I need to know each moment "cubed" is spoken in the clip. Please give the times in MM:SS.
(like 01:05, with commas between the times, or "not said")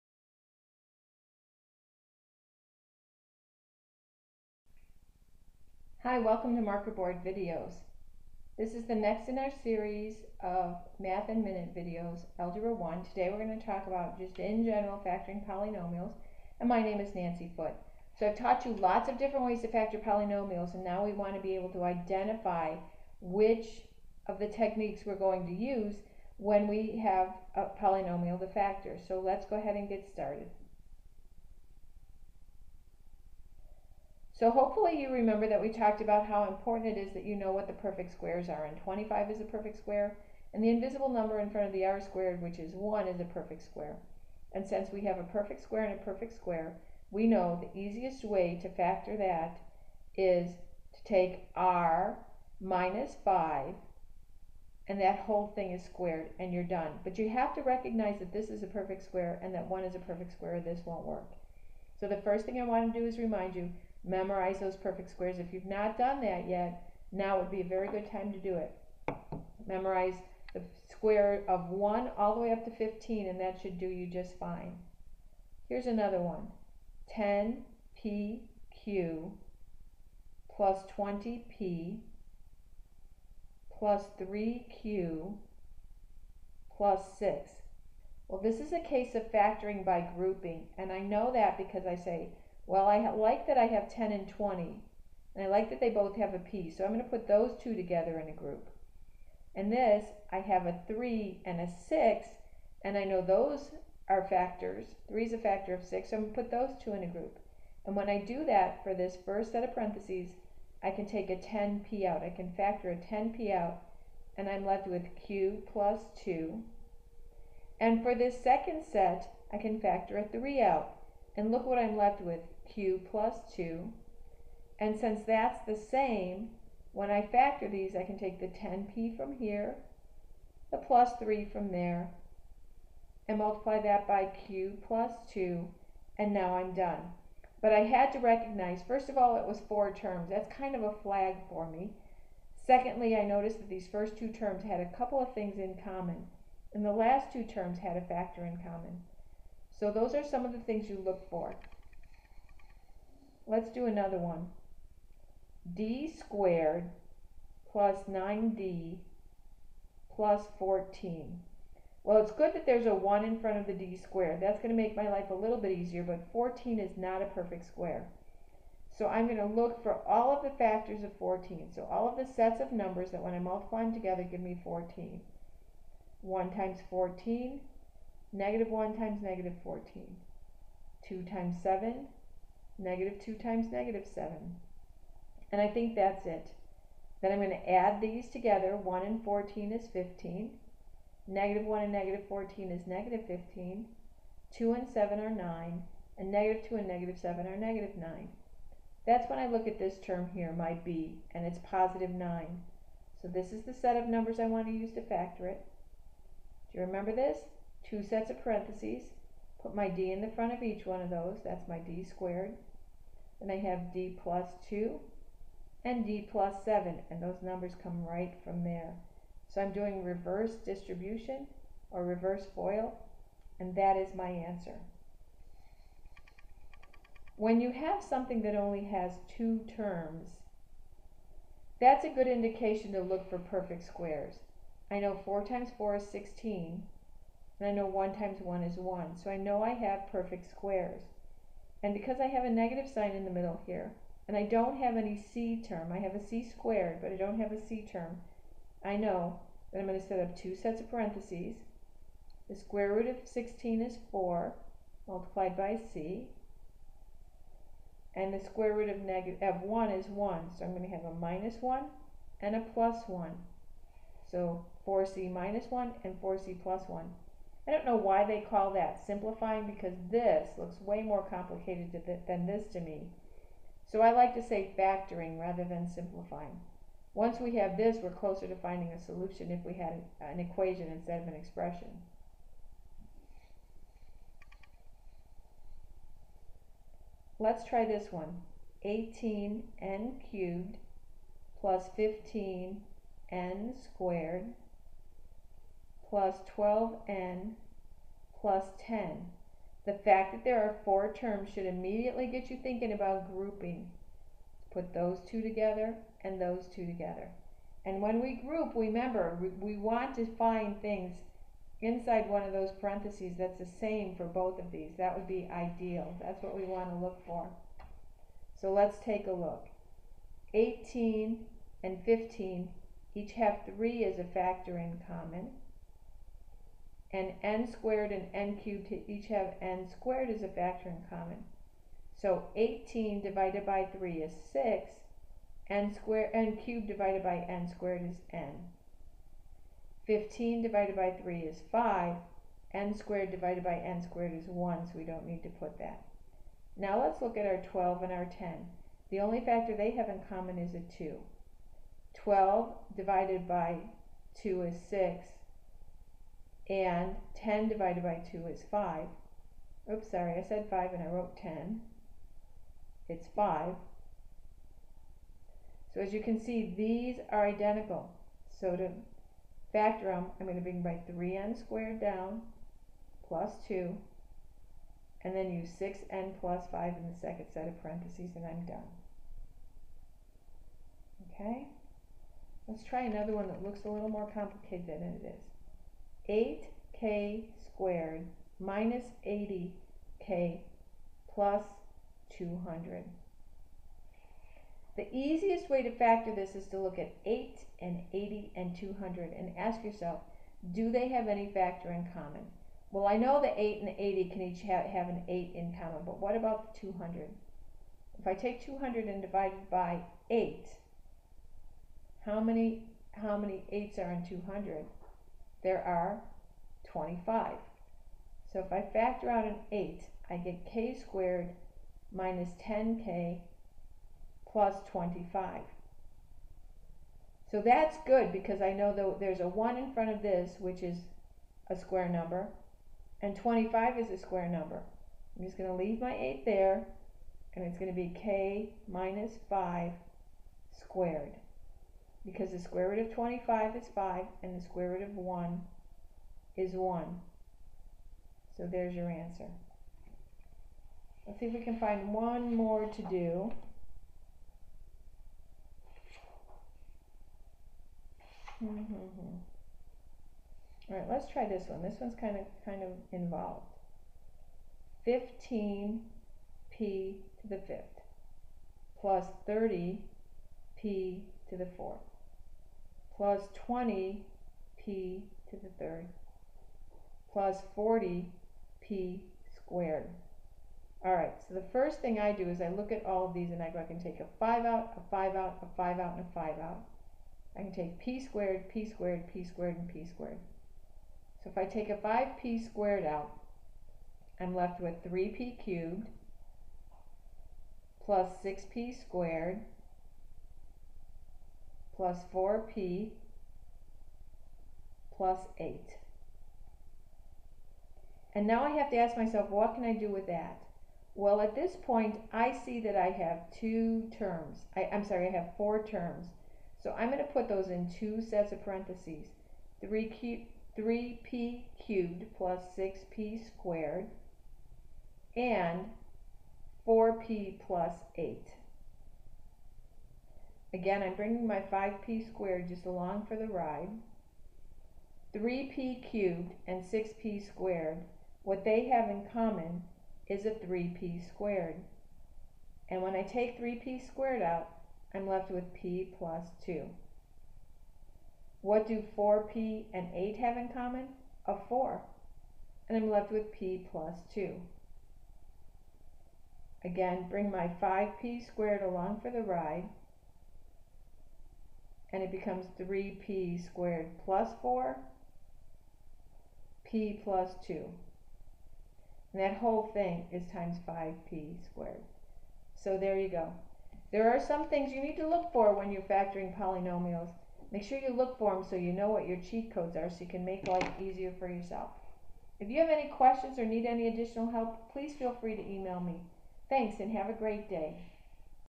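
04:50, 05:28, 05:36, 08:15, 08:41, 08:56.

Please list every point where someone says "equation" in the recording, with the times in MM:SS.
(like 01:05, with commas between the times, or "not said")
04:40.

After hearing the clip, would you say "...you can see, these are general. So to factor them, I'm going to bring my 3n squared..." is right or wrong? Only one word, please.
wrong.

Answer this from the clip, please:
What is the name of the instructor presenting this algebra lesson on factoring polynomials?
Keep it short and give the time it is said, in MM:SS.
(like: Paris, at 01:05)
Nancy Foote, at 00:17.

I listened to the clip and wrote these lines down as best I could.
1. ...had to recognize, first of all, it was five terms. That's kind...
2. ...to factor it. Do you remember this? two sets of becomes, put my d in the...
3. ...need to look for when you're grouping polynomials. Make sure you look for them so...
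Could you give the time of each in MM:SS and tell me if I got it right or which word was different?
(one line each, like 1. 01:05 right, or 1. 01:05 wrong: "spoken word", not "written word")
1. 02:17 wrong: "four", not "five"
2. 03:24 wrong: "parentheses", not "becomes"
3. 09:35 wrong: "factoring", not "grouping".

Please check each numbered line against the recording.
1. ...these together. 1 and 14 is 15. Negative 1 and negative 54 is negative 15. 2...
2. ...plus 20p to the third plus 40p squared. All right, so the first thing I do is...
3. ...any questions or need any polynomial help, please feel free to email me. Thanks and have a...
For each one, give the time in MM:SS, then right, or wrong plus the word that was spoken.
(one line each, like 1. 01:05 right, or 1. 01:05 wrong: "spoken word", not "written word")
1. 03:07 wrong: "14", not "54"
2. 07:53 right
3. 09:42 wrong: "additional", not "polynomial".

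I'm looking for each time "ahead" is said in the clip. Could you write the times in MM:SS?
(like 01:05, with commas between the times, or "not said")
00:29.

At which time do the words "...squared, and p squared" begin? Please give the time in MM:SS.
08:09.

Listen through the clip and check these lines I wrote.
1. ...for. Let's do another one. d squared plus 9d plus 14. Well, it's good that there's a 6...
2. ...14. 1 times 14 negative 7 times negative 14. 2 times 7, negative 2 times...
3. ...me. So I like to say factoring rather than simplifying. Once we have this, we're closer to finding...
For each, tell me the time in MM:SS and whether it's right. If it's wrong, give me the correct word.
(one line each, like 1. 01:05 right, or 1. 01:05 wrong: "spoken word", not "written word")
1. 02:31 wrong: "1", not "6"
2. 02:54 wrong: "1", not "7"
3. 04:32 right.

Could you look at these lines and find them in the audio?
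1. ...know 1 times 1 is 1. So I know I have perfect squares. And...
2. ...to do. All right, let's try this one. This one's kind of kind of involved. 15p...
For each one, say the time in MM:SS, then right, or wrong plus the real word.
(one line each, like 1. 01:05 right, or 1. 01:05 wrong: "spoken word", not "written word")
1. 03:57 right
2. 07:32 right.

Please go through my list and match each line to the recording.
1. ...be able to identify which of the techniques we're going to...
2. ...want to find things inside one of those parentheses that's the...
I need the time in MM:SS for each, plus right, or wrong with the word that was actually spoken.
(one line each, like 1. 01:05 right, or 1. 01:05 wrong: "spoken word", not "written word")
1. 00:21 right
2. 05:09 right.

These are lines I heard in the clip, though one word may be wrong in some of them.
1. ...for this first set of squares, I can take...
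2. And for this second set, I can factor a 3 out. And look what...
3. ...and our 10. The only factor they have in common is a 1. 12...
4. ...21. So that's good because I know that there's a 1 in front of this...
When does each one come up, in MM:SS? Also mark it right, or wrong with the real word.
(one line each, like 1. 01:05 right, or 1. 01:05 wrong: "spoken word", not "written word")
1. 01:48 wrong: "parentheses", not "squares"
2. 01:57 right
3. 05:48 wrong: "2", not "1"
4. 07:04 wrong: "25", not "21".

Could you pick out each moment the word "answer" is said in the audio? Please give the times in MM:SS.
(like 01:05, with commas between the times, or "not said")
03:44, 07:29.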